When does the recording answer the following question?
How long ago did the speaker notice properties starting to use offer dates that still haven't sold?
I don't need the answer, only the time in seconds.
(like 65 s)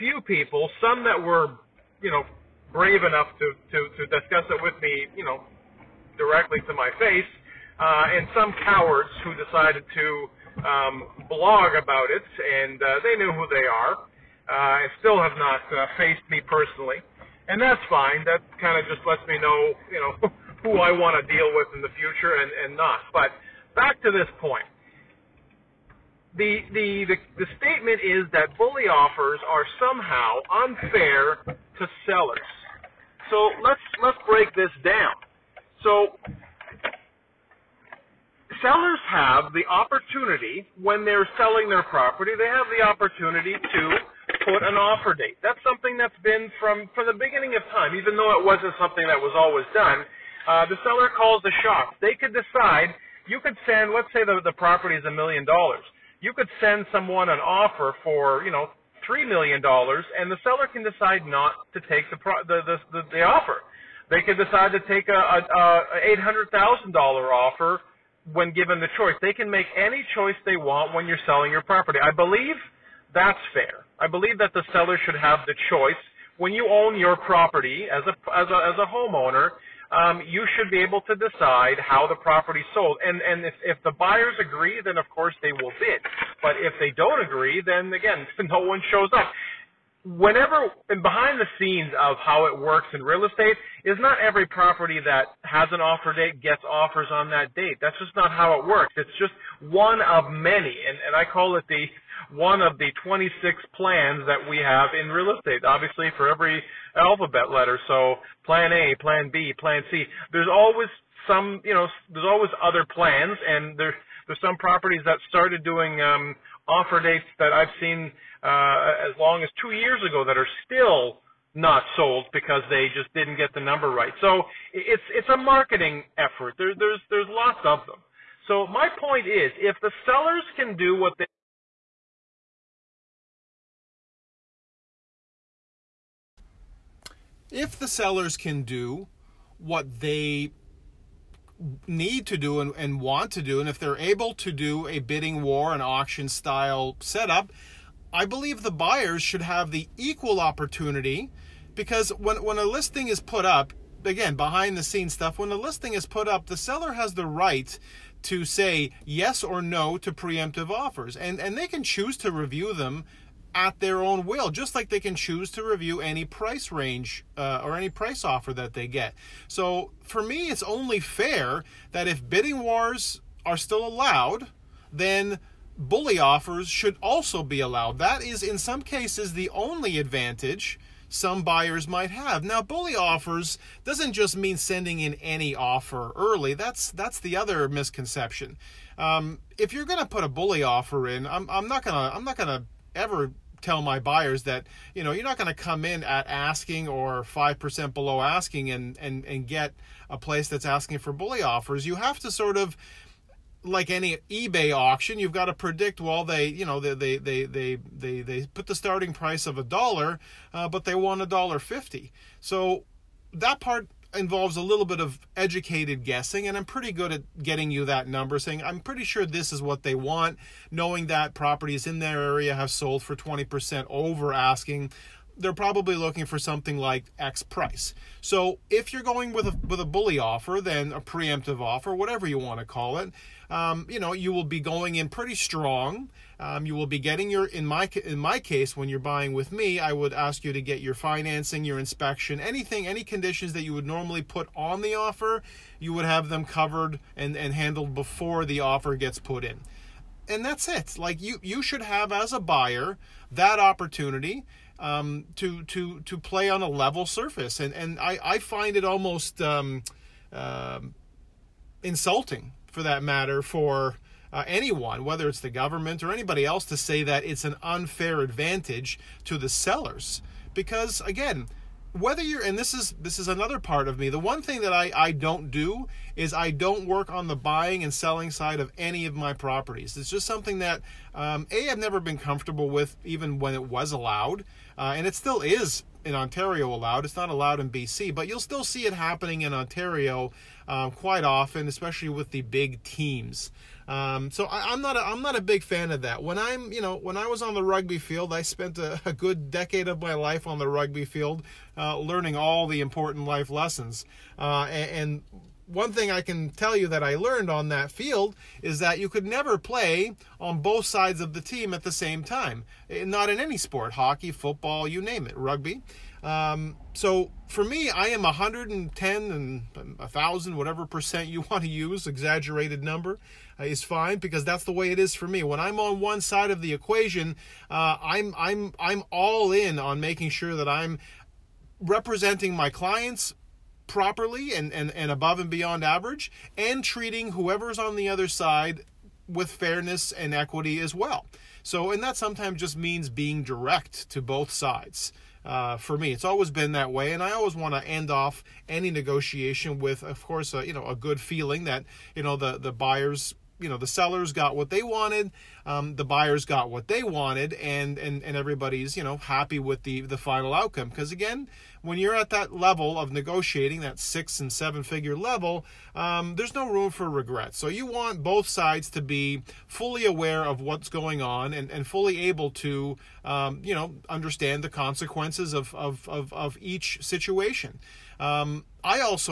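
119 s.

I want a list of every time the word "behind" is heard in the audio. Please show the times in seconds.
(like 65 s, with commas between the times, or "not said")
91 s, 154 s.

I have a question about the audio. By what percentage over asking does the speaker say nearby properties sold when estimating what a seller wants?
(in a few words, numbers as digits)
20%.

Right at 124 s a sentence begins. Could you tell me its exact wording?
So it's it's a marketing effort.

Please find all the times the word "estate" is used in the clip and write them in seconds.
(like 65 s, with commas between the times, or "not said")
93 s, 105 s.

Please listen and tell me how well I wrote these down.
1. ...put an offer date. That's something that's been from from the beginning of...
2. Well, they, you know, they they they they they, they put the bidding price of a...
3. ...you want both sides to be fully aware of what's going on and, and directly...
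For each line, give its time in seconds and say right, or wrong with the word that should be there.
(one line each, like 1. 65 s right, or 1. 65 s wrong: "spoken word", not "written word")
1. 44 s right
2. 205 s wrong: "starting", not "bidding"
3. 367 s wrong: "fully", not "directly".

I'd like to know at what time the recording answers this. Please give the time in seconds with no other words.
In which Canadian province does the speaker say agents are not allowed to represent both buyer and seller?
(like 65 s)
287 s.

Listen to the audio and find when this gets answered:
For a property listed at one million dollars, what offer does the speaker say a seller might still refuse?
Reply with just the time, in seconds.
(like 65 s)
59 s.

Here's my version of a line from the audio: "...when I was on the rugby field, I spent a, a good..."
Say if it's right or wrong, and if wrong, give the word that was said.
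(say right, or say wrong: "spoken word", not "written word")
right.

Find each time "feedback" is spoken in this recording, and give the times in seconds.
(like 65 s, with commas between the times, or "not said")
not said.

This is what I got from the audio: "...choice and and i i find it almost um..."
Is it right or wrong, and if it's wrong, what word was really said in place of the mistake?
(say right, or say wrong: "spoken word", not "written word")
wrong: "surface", not "choice".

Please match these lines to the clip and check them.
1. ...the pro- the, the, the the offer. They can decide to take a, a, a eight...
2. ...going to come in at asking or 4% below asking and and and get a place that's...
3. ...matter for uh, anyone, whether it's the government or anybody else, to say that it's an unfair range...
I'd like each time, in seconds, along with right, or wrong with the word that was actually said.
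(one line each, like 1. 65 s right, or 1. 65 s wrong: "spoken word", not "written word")
1. 62 s right
2. 195 s wrong: "5", not "4"
3. 263 s wrong: "advantage", not "range".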